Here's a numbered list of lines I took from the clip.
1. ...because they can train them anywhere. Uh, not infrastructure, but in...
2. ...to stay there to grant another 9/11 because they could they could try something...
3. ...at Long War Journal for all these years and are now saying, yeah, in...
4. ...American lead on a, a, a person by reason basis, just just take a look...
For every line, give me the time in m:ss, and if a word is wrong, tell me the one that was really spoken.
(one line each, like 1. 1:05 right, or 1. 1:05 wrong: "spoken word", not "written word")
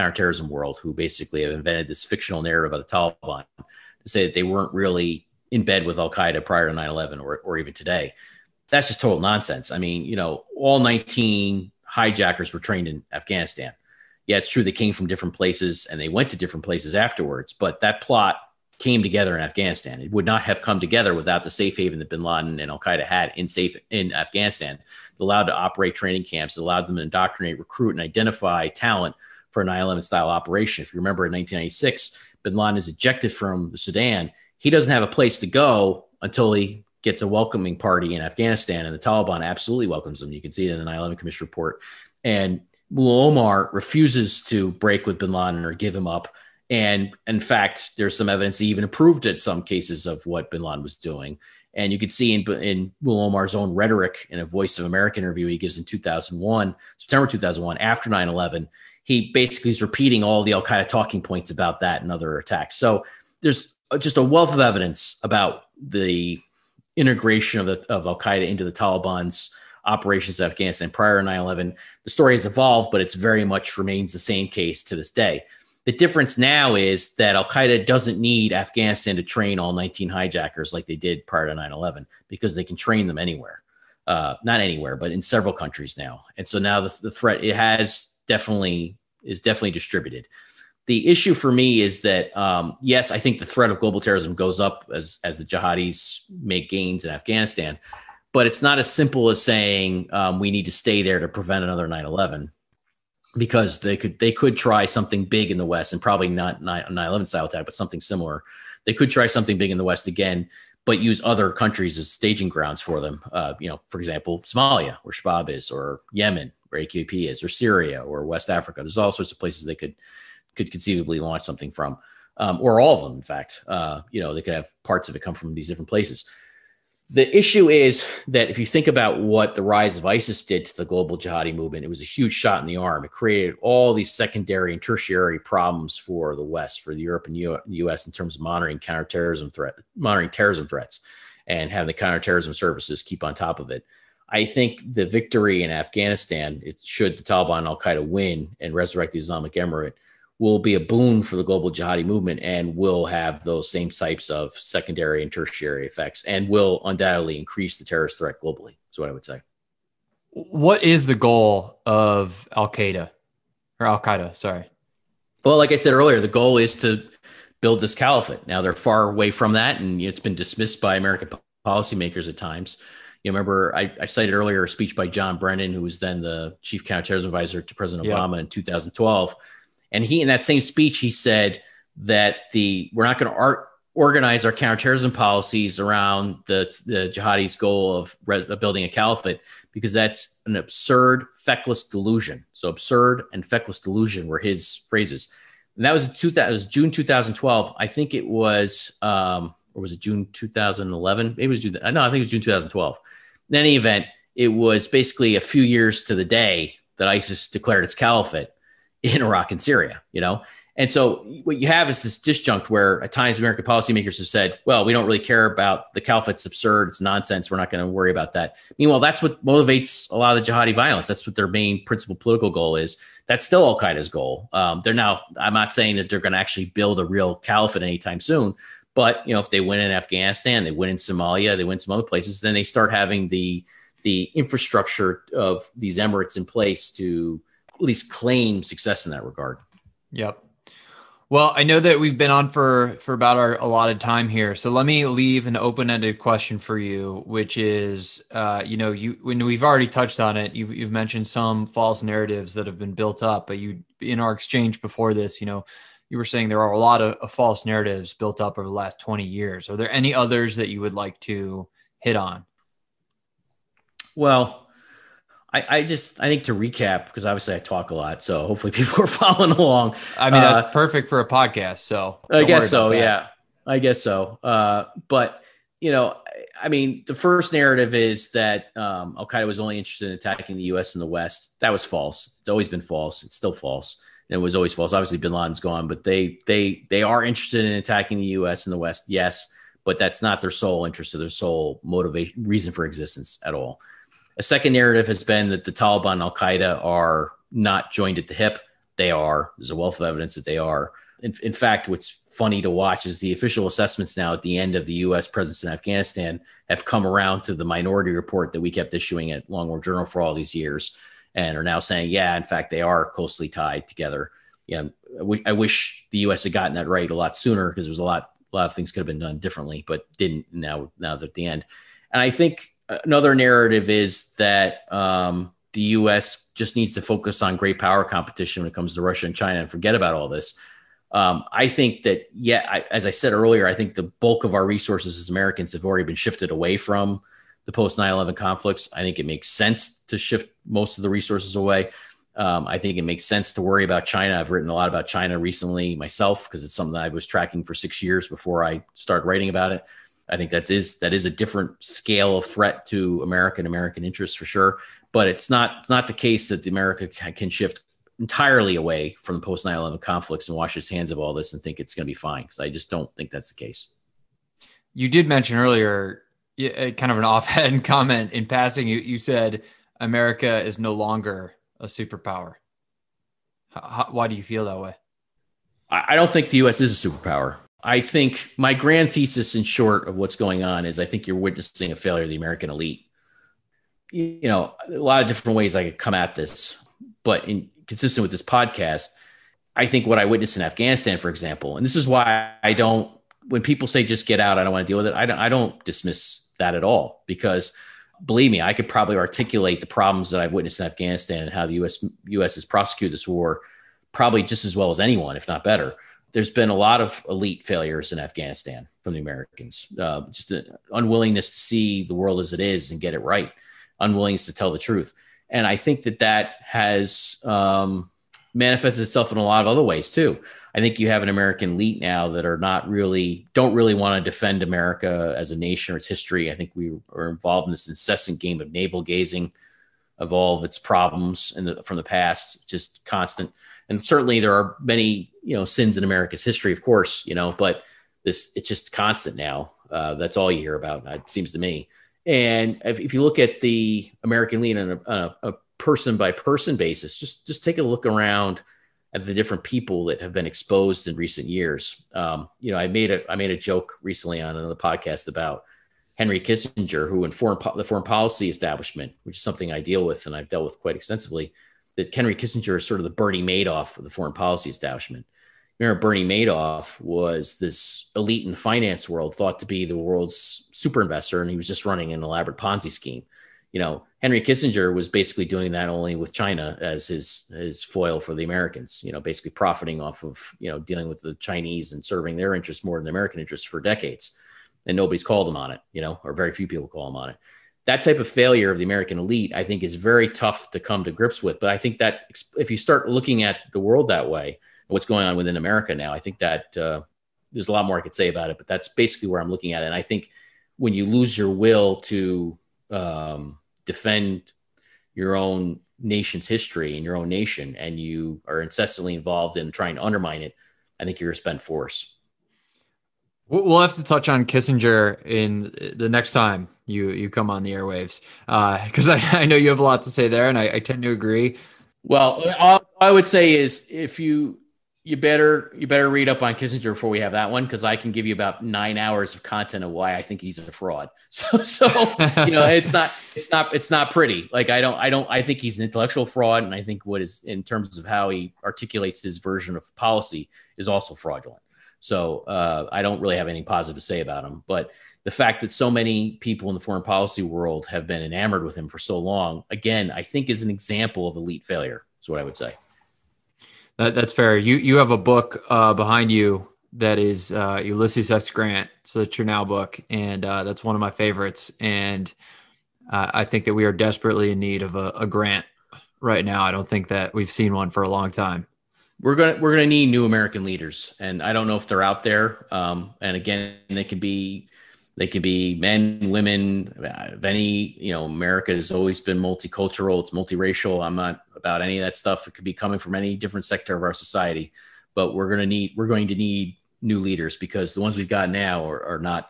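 1. 1:22 wrong: "anywhere", not "infrastructure"
2. 1:40 wrong: "prevent", not "grant"
3. 5:09 right
4. 7:24 wrong: "person", not "reason".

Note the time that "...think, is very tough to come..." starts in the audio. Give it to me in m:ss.
8:09.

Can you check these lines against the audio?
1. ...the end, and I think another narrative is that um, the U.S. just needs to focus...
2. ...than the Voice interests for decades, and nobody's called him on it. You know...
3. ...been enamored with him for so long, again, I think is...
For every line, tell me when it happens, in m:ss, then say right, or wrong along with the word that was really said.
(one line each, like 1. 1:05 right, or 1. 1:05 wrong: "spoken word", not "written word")
1. 5:21 right
2. 8:02 wrong: "American", not "Voice"
3. 9:08 right.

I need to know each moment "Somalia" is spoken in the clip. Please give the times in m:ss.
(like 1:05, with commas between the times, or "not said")
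1:54, 3:50.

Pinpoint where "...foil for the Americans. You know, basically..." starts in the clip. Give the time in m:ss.
7:57.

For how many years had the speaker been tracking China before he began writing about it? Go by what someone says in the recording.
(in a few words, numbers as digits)
6.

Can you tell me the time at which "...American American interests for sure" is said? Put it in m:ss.
5:53.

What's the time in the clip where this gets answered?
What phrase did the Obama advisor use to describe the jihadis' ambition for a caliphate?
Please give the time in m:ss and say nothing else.
3:10.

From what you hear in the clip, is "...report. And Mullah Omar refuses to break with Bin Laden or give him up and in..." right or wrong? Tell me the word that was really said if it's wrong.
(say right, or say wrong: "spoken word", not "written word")
right.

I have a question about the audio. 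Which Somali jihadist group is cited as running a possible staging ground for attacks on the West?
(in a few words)
Shabab.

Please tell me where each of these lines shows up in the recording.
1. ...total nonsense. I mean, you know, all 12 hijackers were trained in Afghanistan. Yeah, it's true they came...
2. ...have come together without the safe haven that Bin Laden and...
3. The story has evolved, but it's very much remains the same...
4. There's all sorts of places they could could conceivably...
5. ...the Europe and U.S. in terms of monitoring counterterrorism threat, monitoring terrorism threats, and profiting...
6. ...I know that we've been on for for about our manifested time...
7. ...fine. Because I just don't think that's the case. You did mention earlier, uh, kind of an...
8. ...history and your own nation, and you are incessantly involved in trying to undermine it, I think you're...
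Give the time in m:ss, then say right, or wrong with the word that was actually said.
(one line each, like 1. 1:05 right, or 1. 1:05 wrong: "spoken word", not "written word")
1. 0:09 wrong: "19", not "12"
2. 0:20 right
3. 1:12 right
4. 1:58 right
5. 2:16 wrong: "having", not "profiting"
6. 4:01 wrong: "allotted", not "manifested"
7. 6:02 right
8. 8:26 right.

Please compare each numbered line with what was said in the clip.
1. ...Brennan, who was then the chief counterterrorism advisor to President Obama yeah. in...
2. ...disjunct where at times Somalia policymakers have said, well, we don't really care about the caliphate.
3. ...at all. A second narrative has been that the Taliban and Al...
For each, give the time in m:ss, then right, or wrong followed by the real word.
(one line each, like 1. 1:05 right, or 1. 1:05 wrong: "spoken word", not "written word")
1. 2:55 right
2. 3:32 wrong: "American", not "Somalia"
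3. 4:53 right.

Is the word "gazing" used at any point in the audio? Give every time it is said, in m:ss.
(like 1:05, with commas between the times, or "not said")
7:09.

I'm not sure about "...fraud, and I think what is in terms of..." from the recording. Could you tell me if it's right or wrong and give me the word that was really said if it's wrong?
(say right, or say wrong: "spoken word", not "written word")
right.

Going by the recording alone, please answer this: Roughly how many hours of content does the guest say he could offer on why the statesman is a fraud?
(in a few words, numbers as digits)
9.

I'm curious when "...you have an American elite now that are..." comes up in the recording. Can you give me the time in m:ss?
7:01.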